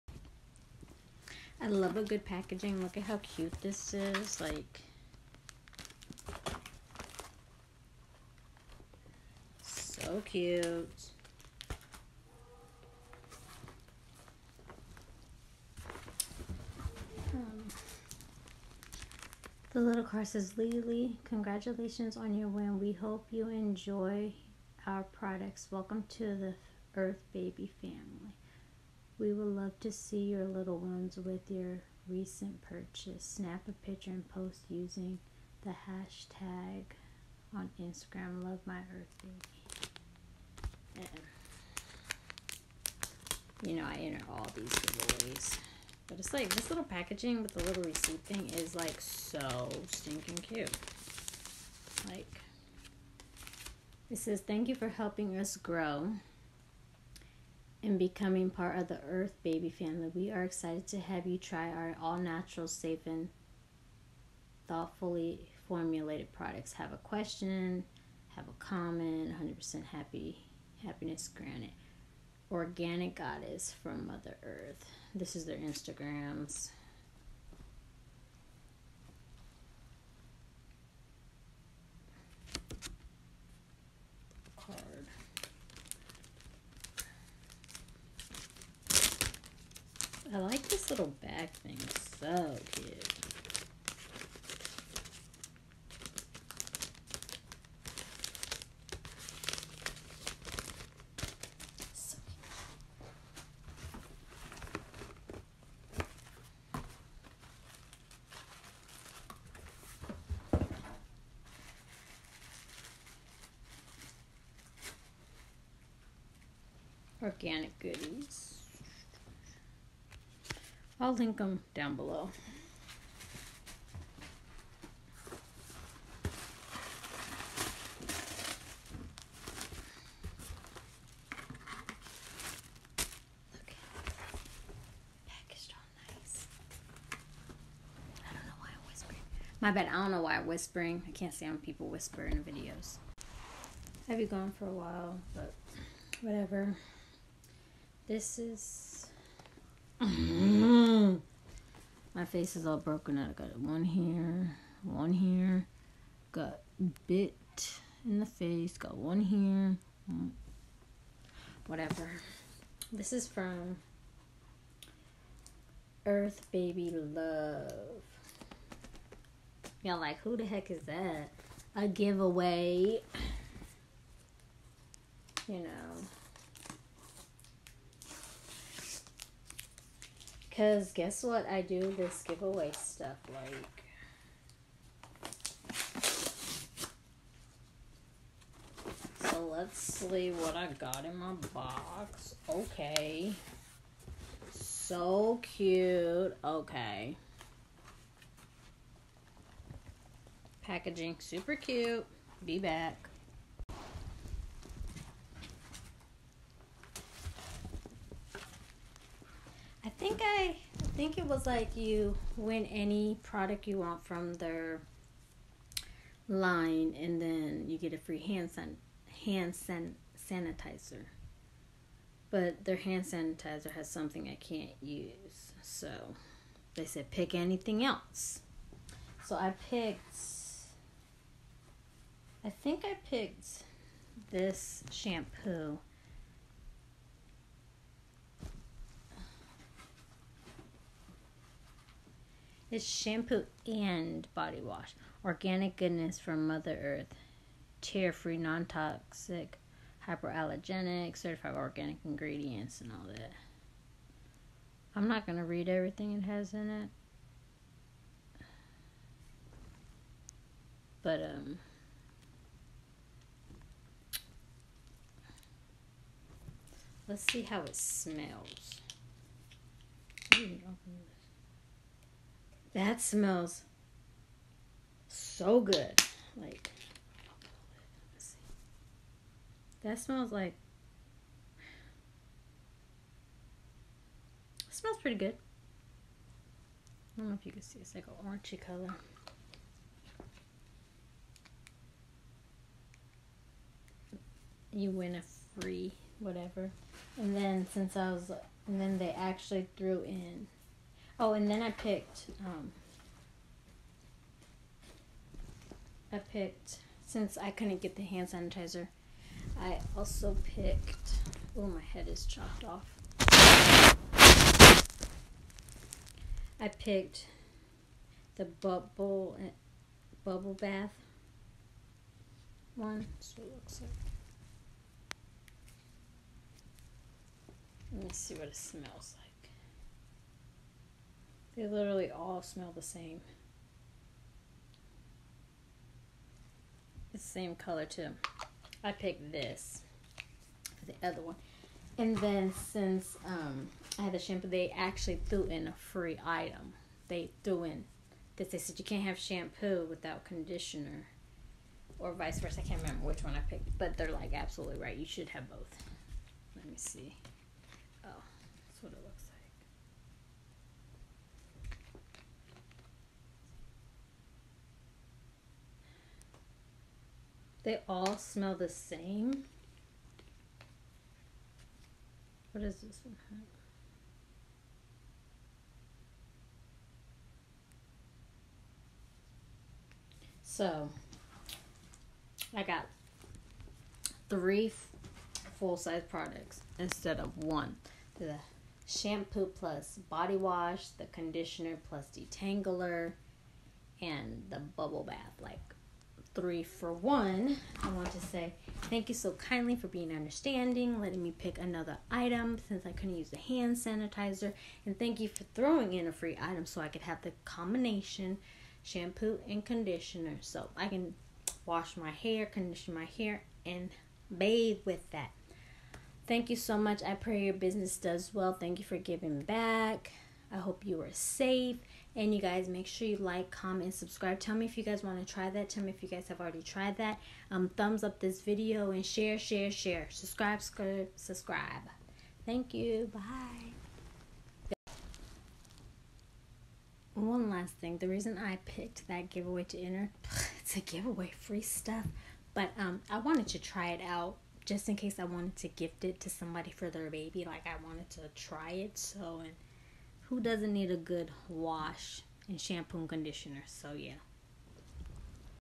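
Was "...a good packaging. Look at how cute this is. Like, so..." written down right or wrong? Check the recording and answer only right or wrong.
right.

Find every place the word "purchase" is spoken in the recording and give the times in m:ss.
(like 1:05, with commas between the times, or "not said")
0:32.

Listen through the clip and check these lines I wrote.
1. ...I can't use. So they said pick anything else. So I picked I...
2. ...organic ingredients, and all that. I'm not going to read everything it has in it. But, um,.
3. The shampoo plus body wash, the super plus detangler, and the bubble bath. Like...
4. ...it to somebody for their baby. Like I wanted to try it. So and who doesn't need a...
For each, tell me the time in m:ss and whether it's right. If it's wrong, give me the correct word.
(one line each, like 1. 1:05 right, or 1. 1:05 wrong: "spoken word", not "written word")
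1. 3:44 right
2. 4:11 right
3. 6:28 wrong: "conditioner", not "super"
4. 7:26 right.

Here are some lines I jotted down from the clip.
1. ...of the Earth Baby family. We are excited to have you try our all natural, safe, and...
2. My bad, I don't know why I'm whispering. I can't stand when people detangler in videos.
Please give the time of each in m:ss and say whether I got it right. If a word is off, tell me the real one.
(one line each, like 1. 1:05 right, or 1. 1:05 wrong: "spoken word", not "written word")
1. 0:58 right
2. 2:19 wrong: "whisper", not "detangler".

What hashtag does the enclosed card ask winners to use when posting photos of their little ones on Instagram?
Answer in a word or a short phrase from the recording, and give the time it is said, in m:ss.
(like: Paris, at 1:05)
Love My Earth Baby, at 0:38.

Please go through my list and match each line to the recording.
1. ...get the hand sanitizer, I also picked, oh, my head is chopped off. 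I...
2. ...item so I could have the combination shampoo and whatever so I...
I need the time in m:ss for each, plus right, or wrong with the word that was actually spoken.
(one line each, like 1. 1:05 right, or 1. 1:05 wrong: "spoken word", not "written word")
1. 5:07 right
2. 6:46 wrong: "conditioner", not "whatever".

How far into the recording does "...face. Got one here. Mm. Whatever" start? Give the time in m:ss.
2:38.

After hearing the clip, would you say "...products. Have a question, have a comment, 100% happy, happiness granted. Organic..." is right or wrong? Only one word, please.
right.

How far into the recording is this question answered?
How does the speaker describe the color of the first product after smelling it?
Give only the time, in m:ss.
4:48.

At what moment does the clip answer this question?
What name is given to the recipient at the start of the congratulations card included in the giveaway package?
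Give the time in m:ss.
0:20.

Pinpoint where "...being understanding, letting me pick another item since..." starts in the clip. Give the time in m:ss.
6:39.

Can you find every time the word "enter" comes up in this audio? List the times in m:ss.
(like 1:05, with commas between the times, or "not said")
0:43, 7:19.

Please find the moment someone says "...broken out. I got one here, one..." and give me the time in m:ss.
2:32.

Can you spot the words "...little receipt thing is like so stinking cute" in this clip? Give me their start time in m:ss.
0:47.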